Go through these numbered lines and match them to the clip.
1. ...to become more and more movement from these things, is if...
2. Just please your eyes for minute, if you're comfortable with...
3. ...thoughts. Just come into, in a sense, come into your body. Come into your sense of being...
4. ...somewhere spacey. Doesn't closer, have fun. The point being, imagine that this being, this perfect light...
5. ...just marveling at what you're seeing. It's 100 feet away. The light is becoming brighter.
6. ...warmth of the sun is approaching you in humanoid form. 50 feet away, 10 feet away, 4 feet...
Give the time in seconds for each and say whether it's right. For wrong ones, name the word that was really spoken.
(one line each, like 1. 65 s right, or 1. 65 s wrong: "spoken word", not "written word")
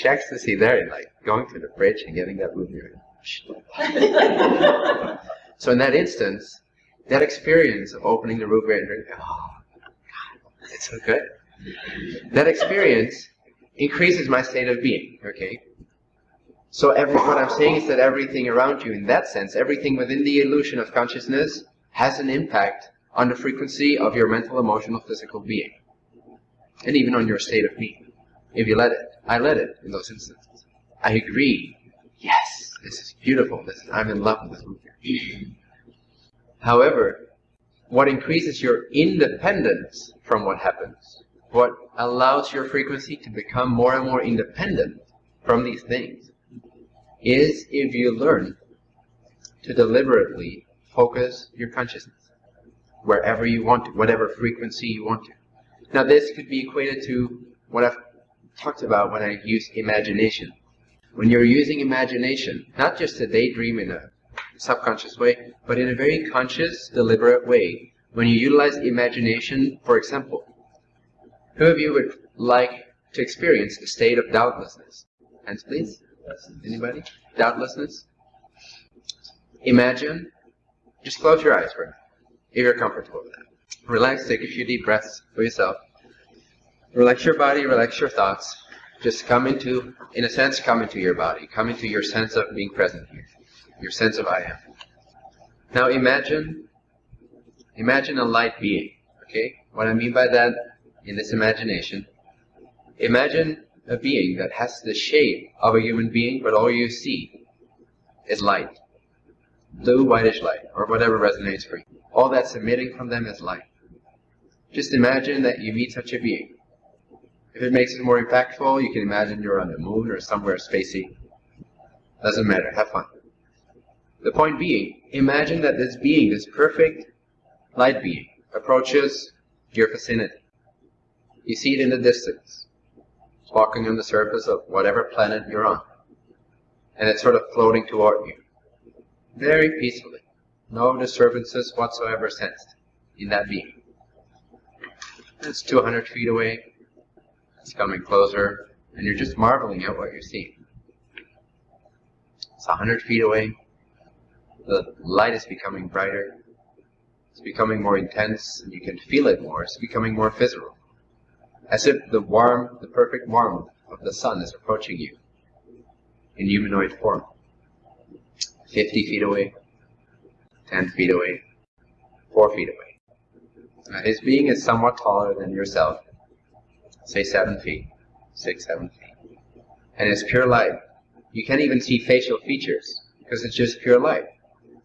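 1. 43 s wrong: "independent", not "movement"
2. 81 s wrong: "close", not "please"
3. 88 s right
4. 120 s wrong: "matter", not "closer"
5. 149 s right
6. 163 s right.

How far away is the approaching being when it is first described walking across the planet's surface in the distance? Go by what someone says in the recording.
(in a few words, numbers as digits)
200 feet.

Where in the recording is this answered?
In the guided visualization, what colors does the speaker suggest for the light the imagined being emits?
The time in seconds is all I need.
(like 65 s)
109 s.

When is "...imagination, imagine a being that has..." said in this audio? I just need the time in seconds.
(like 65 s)
101 s.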